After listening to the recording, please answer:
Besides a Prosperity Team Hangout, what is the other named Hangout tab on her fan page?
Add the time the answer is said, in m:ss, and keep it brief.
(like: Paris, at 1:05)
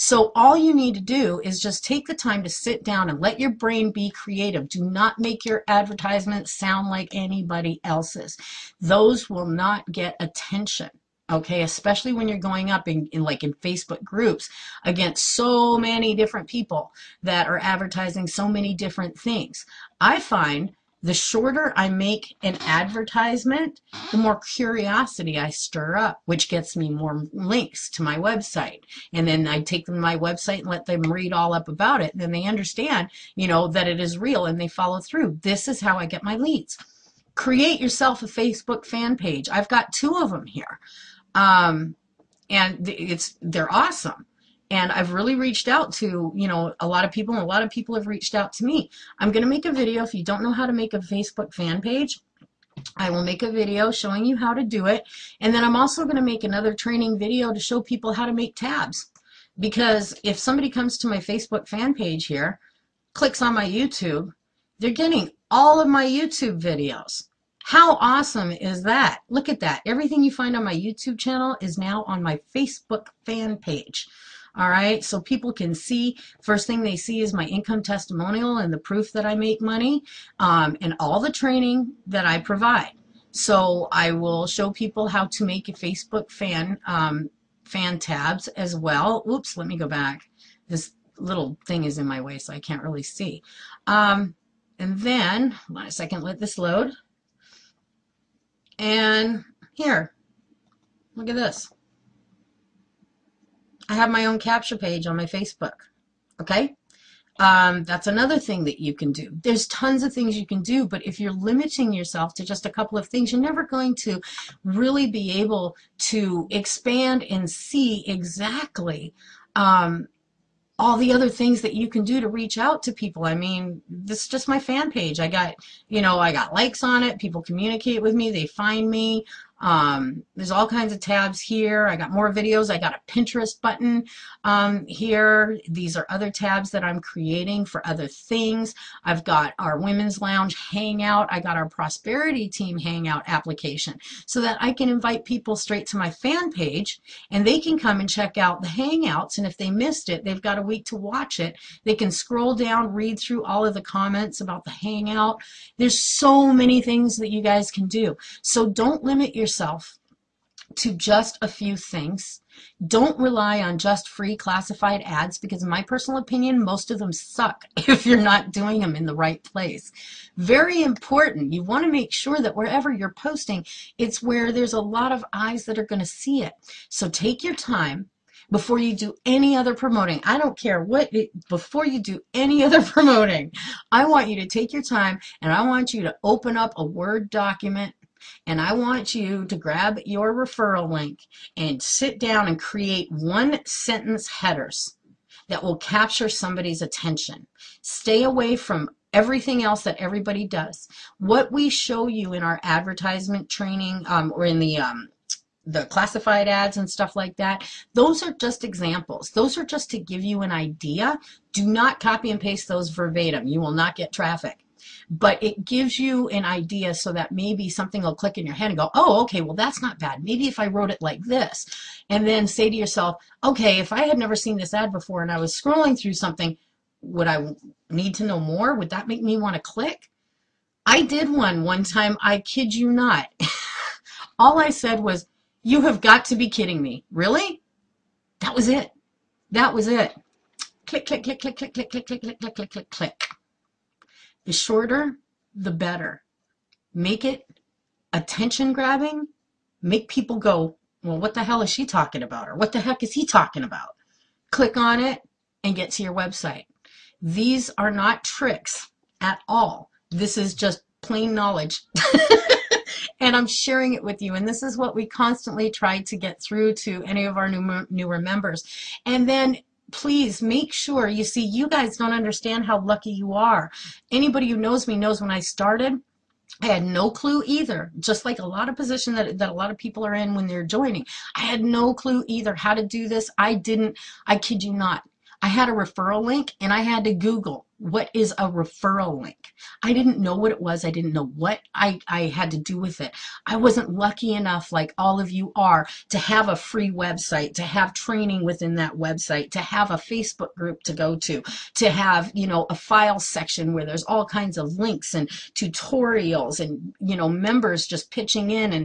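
Women's Lounge Hangout, at 2:19.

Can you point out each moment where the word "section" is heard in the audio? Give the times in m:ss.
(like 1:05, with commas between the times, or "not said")
5:03.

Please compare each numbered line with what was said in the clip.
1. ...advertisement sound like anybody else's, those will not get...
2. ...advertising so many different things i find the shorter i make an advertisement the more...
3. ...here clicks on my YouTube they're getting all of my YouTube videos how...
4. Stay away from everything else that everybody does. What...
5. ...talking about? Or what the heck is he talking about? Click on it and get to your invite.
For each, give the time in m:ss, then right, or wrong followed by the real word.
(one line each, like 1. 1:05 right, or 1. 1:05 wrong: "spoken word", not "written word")
1. 0:05 right
2. 0:17 right
3. 1:02 right
4. 3:17 right
5. 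4:11 wrong: "website", not "invite".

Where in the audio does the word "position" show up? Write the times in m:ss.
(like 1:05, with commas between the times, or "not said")
4:38.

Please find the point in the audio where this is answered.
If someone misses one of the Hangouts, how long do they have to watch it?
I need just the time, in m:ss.
2:30.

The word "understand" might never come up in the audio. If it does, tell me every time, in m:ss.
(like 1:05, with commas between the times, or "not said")
0:32, 4:32.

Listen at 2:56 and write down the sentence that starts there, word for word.
So take your time before you do any other promoting.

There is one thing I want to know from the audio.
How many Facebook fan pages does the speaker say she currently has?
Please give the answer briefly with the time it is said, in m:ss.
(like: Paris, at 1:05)
2, at 0:39.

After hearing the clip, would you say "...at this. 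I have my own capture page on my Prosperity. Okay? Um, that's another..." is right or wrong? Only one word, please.
wrong.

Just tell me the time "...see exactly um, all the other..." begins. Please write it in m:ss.
1:57.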